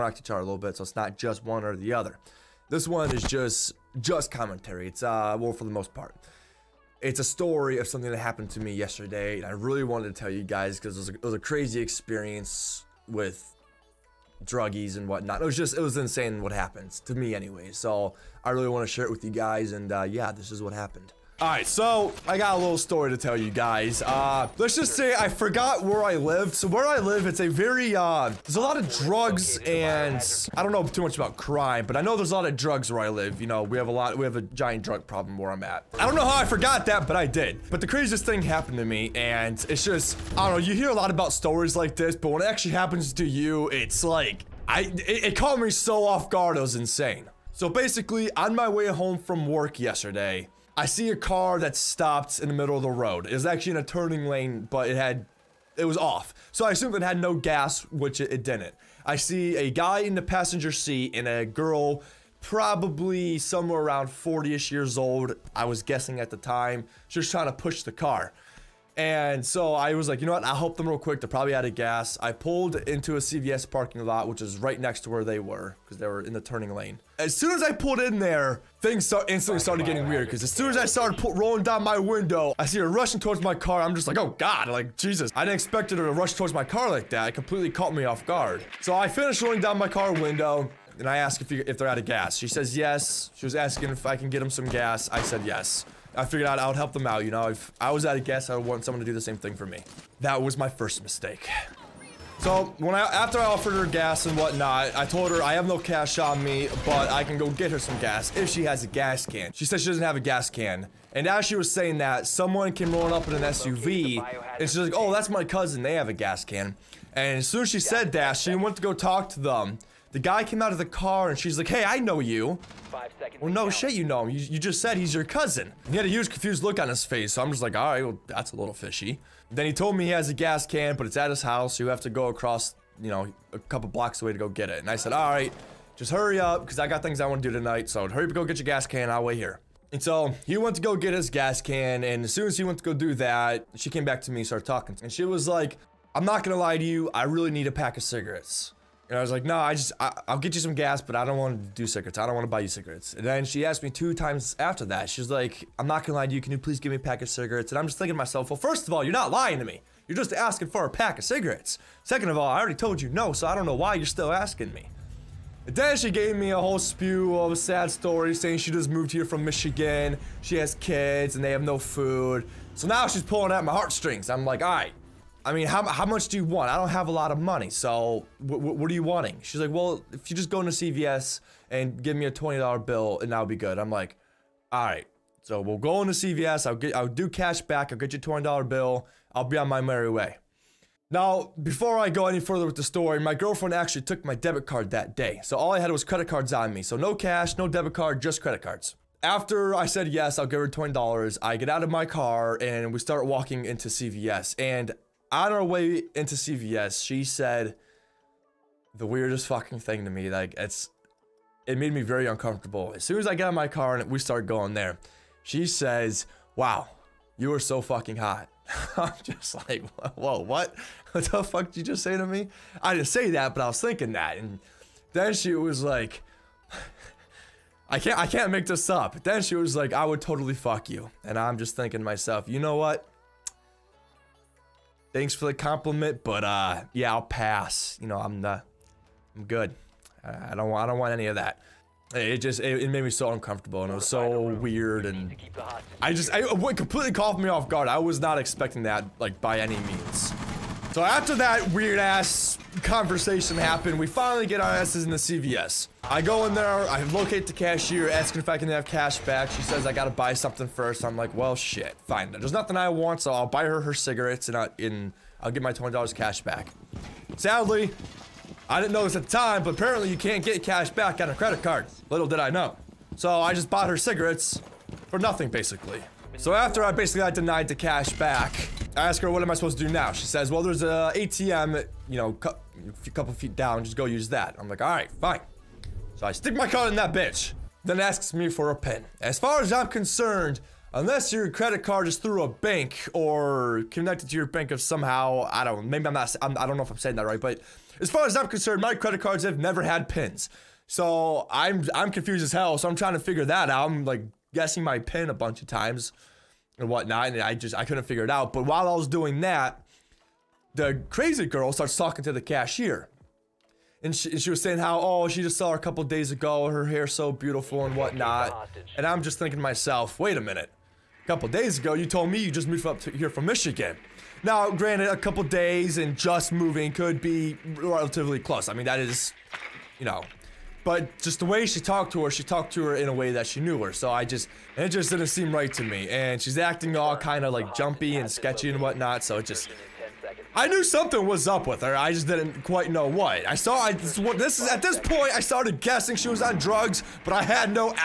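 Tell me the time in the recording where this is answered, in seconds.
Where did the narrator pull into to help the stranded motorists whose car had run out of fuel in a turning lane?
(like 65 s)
73 s.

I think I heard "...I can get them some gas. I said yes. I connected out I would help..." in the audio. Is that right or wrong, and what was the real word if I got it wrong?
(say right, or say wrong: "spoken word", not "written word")
wrong: "figured", not "connected".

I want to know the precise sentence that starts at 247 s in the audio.
I was not expecting that, like by any means.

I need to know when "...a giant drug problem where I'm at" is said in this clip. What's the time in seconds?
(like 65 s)
34 s.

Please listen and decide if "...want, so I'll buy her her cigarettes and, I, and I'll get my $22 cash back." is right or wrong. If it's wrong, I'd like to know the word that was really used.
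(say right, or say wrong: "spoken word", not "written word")
wrong: "20", not "22".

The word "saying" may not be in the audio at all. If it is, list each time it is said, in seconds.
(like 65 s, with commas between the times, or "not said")
111 s, 168 s, 296 s, 314 s.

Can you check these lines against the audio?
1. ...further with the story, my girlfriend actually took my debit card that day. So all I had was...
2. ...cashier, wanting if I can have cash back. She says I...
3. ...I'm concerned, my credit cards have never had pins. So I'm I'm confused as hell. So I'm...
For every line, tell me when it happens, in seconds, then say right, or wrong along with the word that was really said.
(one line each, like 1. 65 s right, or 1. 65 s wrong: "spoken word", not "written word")
1. 192 s right
2. 257 s wrong: "asking", not "wanting"
3. 298 s right.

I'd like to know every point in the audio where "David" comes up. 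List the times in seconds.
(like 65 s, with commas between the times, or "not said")
not said.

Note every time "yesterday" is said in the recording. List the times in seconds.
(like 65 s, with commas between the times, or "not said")
8 s, 49 s.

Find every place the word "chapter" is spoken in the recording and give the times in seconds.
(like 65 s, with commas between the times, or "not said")
not said.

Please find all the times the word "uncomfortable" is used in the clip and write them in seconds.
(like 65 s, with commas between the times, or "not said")
212 s, 243 s.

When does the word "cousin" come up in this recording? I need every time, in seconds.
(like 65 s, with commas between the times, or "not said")
115 s, 125 s.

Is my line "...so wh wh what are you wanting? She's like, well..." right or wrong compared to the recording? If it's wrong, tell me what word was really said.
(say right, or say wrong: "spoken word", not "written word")
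right.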